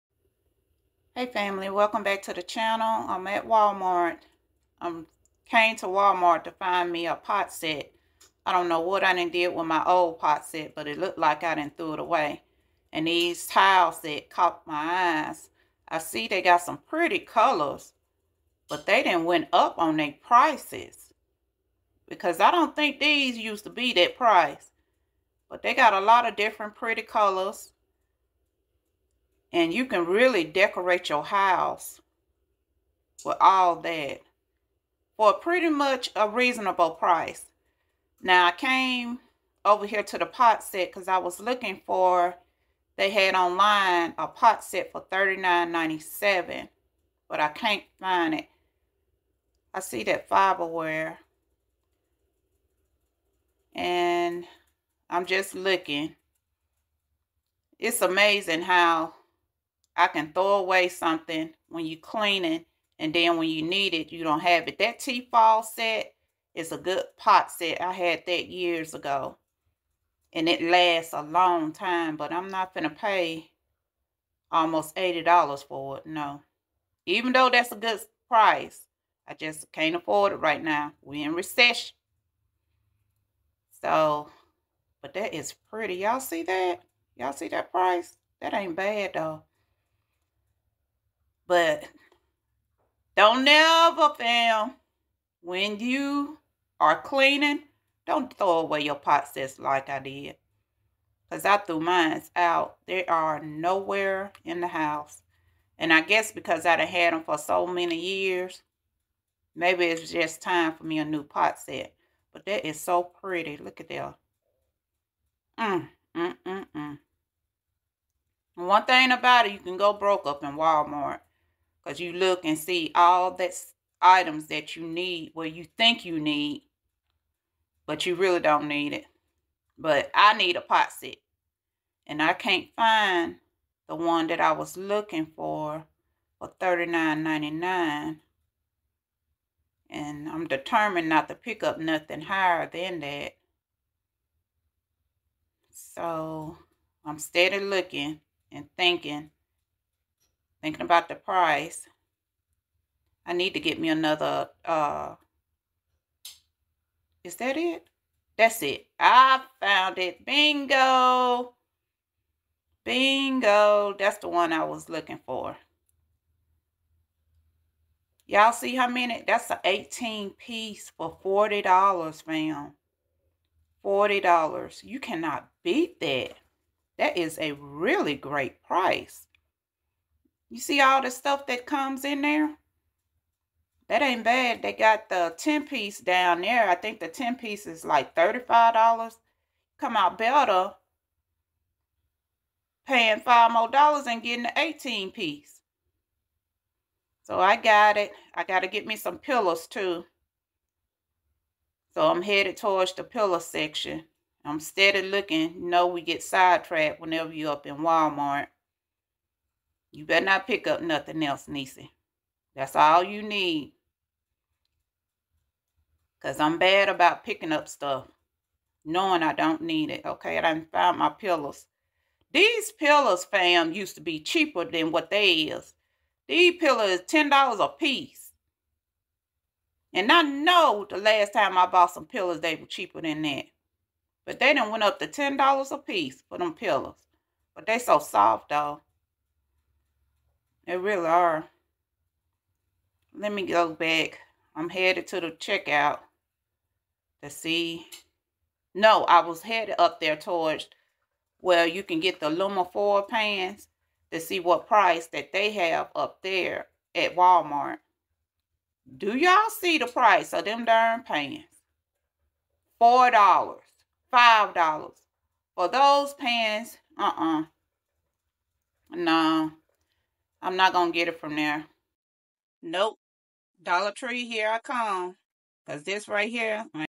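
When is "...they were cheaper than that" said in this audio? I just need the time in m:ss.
3:52.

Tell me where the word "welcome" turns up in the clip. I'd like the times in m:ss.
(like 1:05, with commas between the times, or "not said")
0:01.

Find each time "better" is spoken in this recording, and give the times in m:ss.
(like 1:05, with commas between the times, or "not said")
3:10, 3:30.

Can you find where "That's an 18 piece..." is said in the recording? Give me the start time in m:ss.
2:49.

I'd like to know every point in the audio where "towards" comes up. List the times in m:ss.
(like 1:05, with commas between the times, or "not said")
3:22, 4:10.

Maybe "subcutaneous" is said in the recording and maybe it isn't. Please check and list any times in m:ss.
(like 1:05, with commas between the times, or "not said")
not said.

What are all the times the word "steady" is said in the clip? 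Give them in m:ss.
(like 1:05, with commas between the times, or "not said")
2:27, 3:24.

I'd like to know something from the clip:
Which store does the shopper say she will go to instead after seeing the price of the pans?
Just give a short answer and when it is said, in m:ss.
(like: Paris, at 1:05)
Dollar Tree, at 4:33.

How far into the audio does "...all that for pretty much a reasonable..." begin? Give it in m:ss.
0:33.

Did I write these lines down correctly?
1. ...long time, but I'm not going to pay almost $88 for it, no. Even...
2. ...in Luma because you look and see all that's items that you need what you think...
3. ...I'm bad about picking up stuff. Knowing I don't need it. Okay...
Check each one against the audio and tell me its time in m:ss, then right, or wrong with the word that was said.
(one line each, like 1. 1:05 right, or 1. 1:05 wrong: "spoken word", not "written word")
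1. 1:11 wrong: "80", not "88"
2. 2:00 wrong: "Walmart", not "Luma"
3. 3:36 right.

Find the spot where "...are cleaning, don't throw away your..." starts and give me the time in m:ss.
1:36.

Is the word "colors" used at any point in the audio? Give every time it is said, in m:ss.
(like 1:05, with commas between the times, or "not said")
0:17, 0:27.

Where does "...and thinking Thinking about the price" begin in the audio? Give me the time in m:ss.
2:28.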